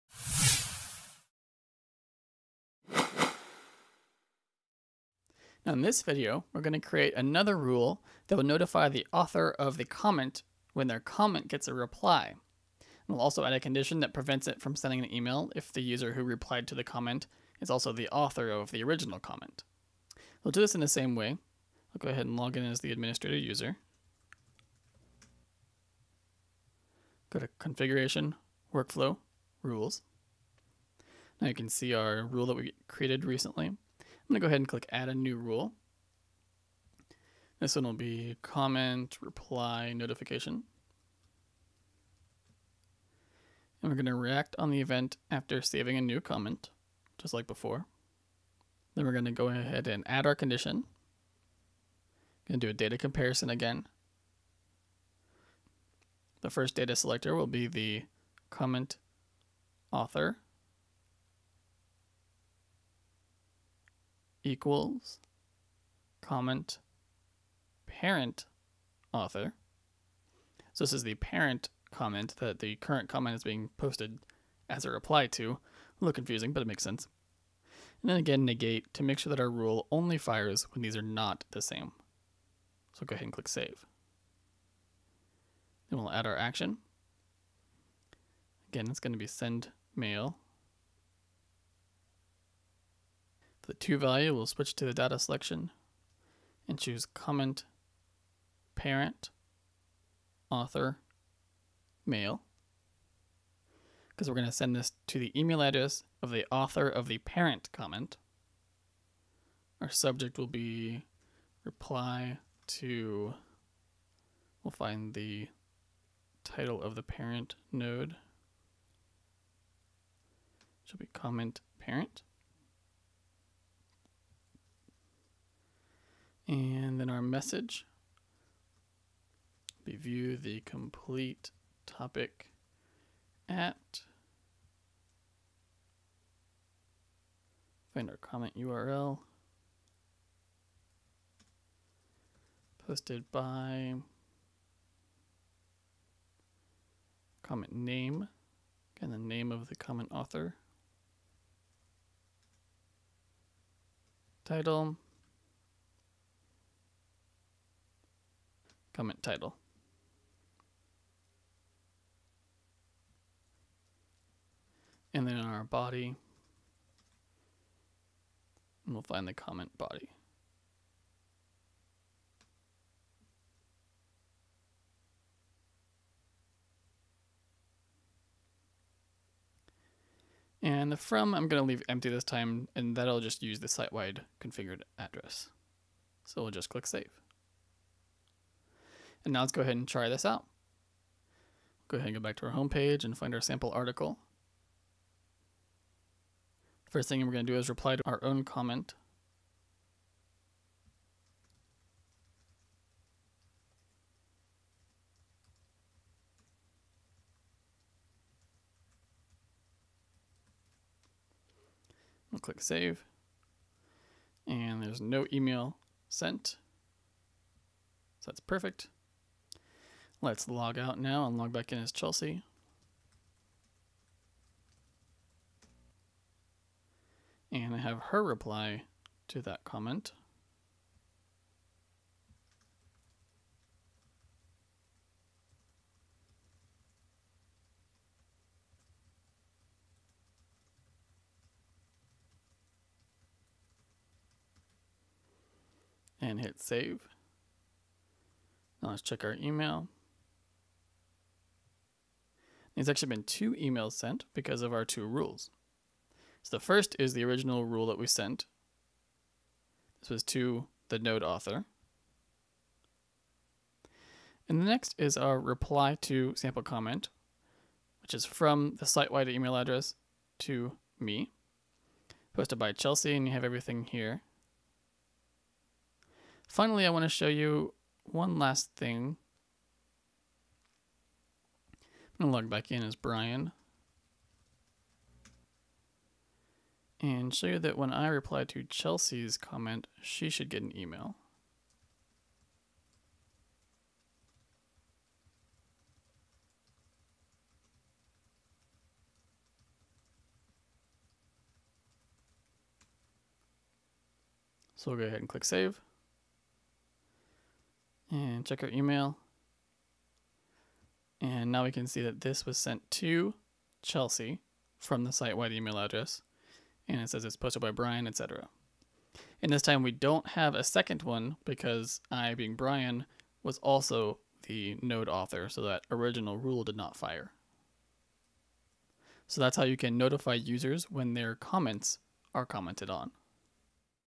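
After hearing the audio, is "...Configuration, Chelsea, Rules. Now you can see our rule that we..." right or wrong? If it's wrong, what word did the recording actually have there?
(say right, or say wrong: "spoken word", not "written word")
wrong: "Workflow", not "Chelsea".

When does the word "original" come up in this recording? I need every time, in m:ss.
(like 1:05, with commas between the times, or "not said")
0:18, 4:17, 5:25.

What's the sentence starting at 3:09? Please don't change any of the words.
And now let's go ahead and try this out.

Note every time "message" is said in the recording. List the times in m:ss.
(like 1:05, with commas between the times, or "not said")
2:07.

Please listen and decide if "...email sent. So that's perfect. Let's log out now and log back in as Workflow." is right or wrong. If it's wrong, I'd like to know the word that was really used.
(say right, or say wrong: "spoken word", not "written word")
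wrong: "Chelsea", not "Workflow".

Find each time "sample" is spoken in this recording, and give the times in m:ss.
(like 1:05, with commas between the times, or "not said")
3:13, 4:26.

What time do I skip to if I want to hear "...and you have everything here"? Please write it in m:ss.
4:33.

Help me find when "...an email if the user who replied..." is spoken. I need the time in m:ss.
0:15.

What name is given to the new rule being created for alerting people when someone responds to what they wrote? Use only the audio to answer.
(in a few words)
comment reply notification.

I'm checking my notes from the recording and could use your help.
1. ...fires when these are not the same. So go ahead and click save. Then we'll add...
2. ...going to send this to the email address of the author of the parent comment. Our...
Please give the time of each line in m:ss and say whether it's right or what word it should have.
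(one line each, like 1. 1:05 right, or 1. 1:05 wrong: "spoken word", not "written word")
1. 1:20 right
2. 1:44 right.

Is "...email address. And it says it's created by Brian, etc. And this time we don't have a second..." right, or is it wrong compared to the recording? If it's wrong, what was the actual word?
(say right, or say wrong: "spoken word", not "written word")
wrong: "posted", not "created".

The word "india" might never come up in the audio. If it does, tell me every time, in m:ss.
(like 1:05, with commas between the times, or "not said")
not said.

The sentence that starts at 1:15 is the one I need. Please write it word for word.
A little confusing, but it makes sense.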